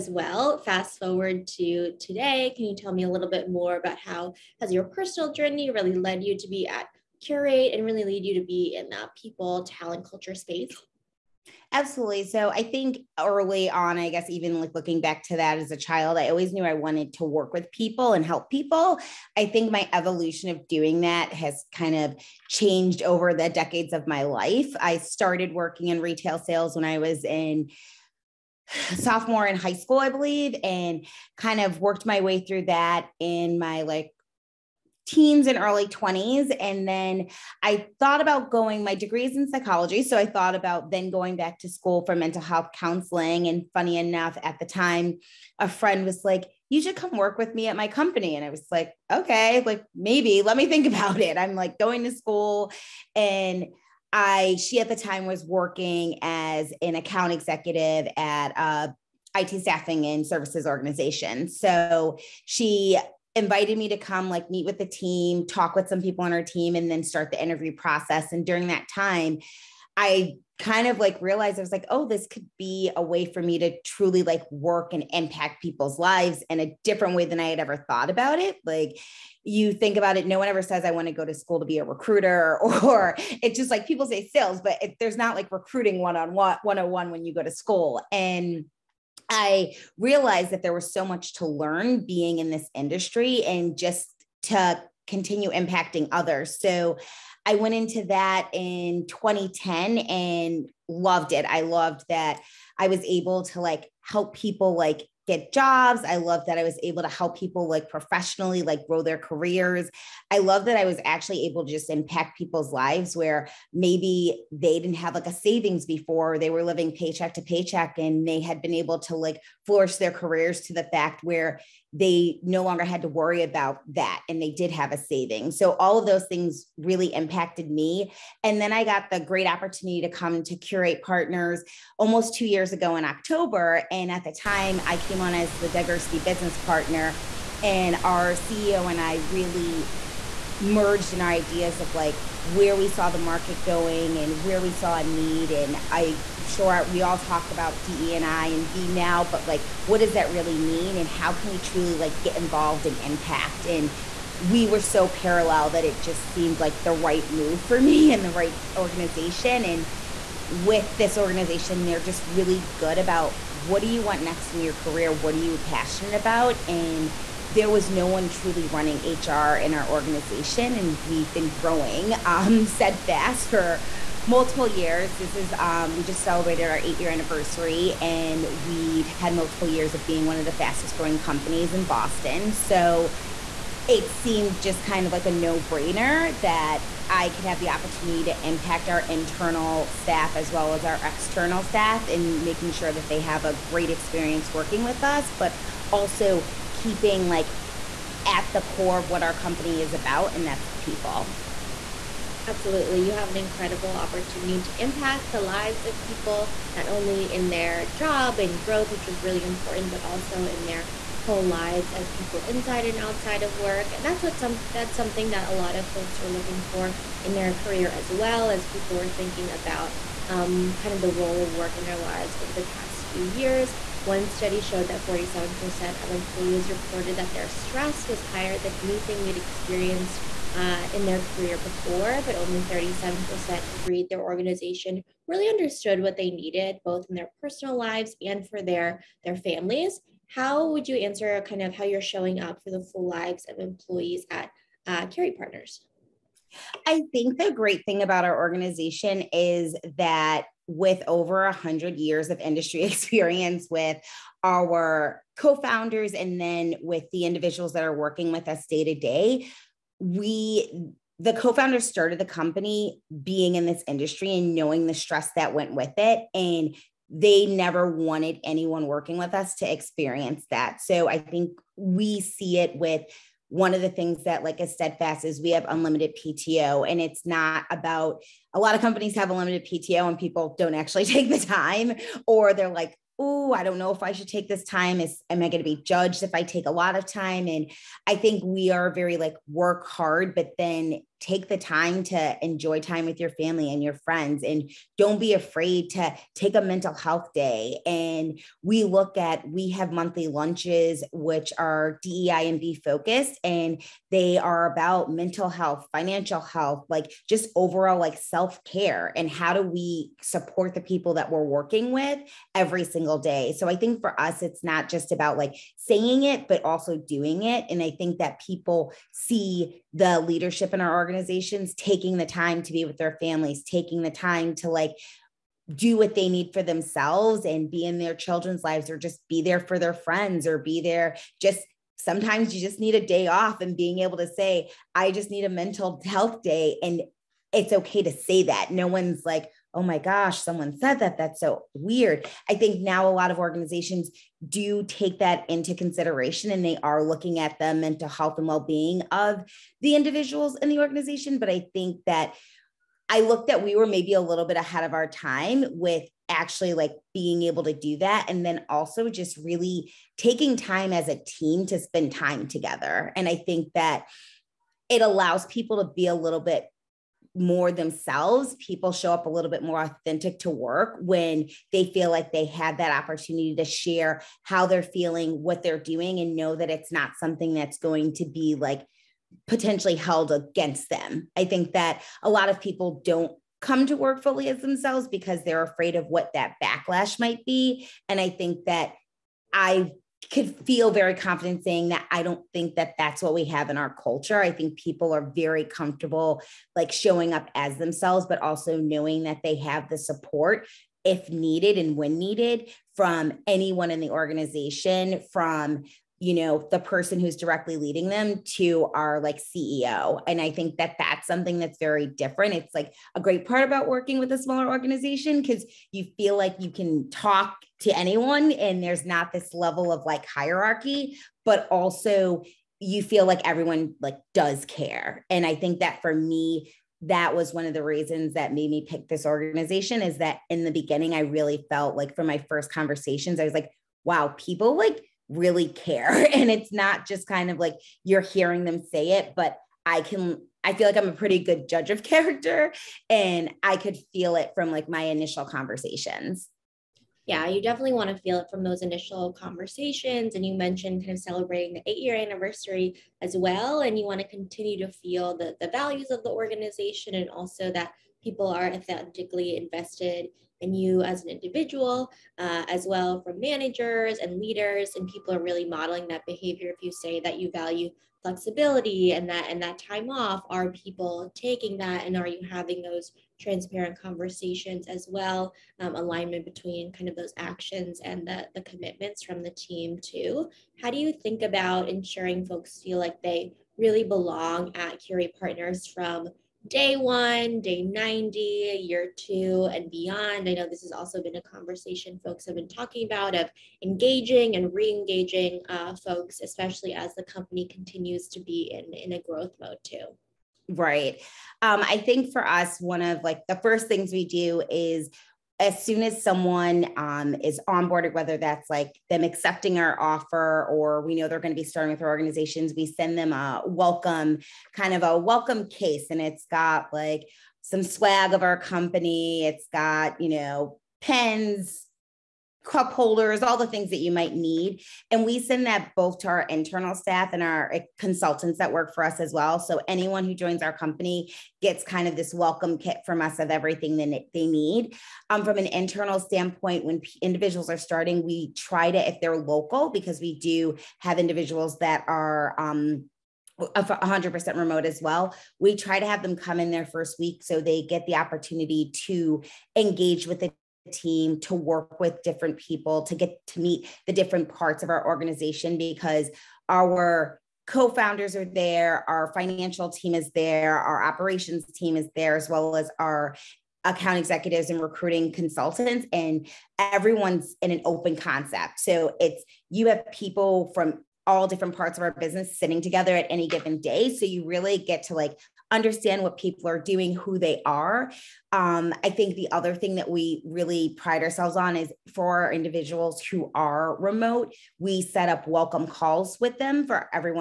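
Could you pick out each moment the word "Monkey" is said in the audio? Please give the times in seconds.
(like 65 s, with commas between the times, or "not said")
not said.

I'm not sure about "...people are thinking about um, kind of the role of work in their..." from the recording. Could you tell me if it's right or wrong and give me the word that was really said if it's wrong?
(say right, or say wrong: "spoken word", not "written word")
right.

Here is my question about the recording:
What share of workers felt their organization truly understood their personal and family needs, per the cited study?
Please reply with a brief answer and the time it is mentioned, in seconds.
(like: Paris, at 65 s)
37%, at 232 s.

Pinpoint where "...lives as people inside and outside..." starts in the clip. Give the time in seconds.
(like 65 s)
211 s.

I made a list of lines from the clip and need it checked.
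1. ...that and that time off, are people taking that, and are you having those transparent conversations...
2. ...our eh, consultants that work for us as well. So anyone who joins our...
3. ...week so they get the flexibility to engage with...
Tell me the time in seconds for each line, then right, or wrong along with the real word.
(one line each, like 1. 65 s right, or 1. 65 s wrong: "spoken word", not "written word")
1. 469 s right
2. 527 s right
3. 547 s wrong: "opportunity", not "flexibility".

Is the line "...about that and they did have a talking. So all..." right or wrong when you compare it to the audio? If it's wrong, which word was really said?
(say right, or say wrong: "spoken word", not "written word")
wrong: "saving", not "talking".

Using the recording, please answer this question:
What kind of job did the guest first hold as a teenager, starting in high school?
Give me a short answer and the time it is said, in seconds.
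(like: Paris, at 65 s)
Retail sales, at 25 s.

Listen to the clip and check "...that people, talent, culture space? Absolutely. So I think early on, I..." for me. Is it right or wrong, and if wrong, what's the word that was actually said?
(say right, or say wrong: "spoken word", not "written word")
right.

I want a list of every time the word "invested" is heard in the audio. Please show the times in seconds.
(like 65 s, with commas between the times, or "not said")
459 s.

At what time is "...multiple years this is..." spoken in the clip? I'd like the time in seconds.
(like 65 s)
174 s.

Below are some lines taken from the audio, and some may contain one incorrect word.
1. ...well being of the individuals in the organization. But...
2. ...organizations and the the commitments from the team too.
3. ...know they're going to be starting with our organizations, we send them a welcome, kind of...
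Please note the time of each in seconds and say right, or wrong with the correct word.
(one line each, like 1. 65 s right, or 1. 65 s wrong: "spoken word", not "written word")
1. 348 s right
2. 477 s wrong: "actions", not "organizations"
3. 511 s right.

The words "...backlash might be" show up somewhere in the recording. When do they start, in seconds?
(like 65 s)
386 s.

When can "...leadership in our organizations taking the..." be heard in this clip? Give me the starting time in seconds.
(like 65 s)
320 s.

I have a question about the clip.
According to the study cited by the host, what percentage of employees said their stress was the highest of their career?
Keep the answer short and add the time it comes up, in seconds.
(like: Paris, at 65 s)
47%, at 225 s.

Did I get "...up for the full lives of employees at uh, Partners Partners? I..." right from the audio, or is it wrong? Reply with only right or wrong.
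wrong.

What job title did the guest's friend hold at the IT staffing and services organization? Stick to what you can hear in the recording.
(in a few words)
Account executive.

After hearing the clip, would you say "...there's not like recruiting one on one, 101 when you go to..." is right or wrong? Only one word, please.
right.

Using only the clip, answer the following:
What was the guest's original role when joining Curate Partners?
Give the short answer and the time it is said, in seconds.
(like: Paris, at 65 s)
Diversity business partner, at 135 s.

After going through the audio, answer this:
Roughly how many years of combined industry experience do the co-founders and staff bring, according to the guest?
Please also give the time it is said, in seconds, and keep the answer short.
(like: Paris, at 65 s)
Over 100 years, at 251 s.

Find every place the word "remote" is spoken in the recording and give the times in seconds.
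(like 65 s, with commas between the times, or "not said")
544 s, 583 s.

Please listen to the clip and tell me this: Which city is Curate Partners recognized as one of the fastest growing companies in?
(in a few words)
Boston.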